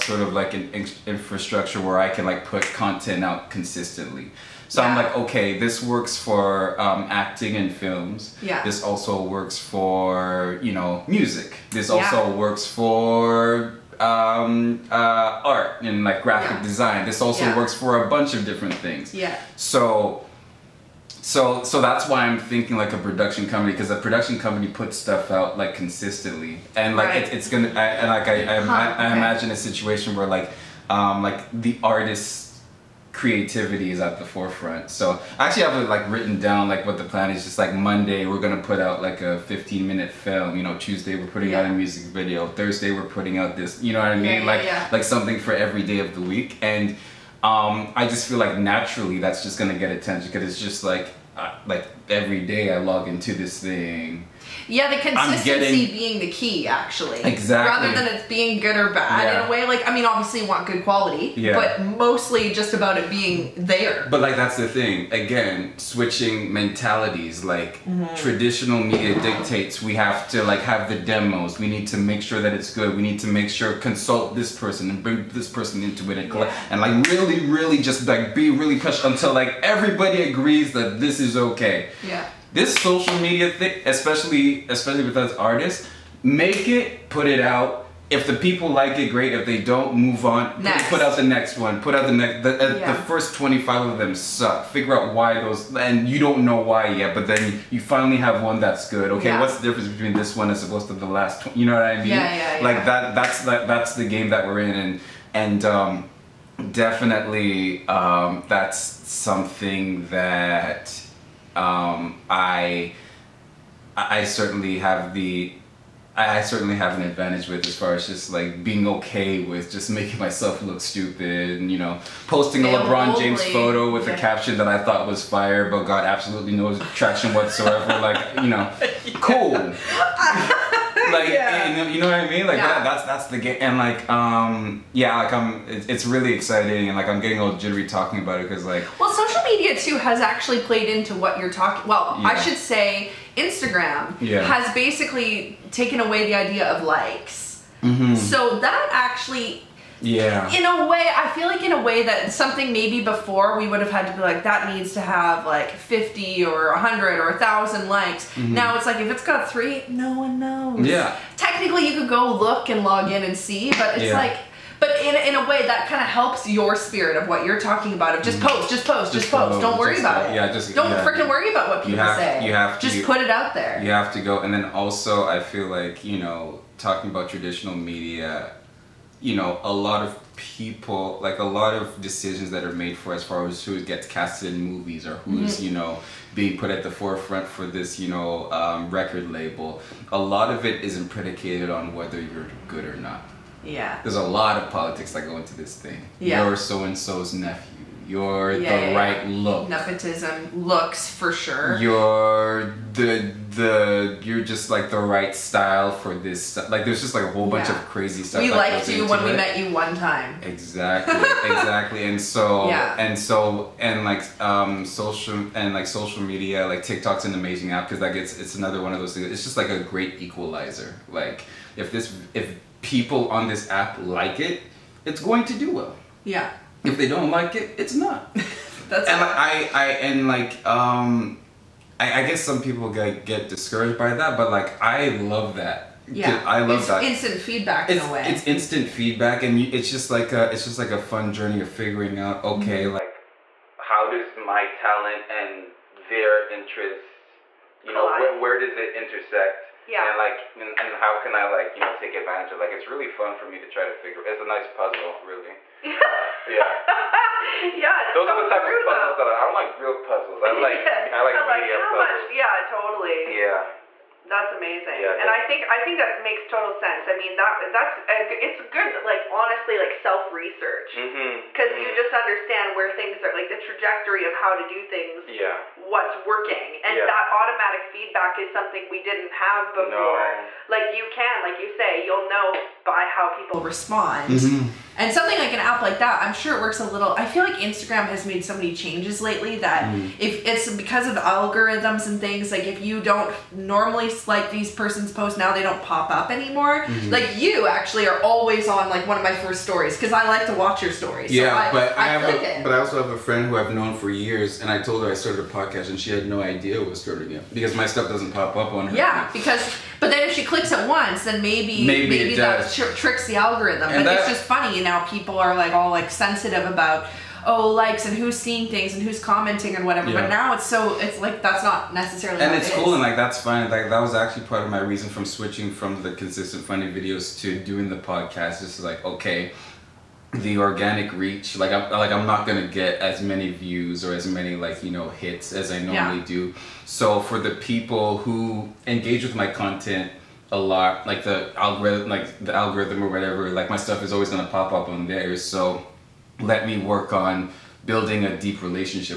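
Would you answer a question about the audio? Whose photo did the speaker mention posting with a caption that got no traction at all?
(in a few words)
LeBron James.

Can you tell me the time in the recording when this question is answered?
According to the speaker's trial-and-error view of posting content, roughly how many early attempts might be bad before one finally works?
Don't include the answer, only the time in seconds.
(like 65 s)
93 s.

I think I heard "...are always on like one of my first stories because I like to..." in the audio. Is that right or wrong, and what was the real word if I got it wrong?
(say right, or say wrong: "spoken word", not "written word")
right.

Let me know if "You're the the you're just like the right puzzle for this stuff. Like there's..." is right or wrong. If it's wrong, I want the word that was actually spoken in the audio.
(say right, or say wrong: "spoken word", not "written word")
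wrong: "style", not "puzzle".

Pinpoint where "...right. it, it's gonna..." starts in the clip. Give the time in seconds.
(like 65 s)
27 s.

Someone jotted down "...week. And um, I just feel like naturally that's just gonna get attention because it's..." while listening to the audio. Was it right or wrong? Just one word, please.
right.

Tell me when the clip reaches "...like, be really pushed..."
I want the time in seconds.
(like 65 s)
78 s.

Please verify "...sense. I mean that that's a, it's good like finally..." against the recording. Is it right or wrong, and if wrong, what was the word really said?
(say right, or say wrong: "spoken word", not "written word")
wrong: "honestly", not "finally".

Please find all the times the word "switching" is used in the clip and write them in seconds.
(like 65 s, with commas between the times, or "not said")
65 s, 325 s.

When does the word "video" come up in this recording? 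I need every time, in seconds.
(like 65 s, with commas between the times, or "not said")
42 s, 326 s.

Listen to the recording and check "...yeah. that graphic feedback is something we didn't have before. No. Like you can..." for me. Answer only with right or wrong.
wrong.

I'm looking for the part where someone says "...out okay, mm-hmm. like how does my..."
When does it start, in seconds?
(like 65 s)
242 s.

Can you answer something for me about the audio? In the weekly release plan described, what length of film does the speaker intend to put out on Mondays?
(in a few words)
15 minute film.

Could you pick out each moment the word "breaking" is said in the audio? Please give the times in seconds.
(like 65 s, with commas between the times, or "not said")
not said.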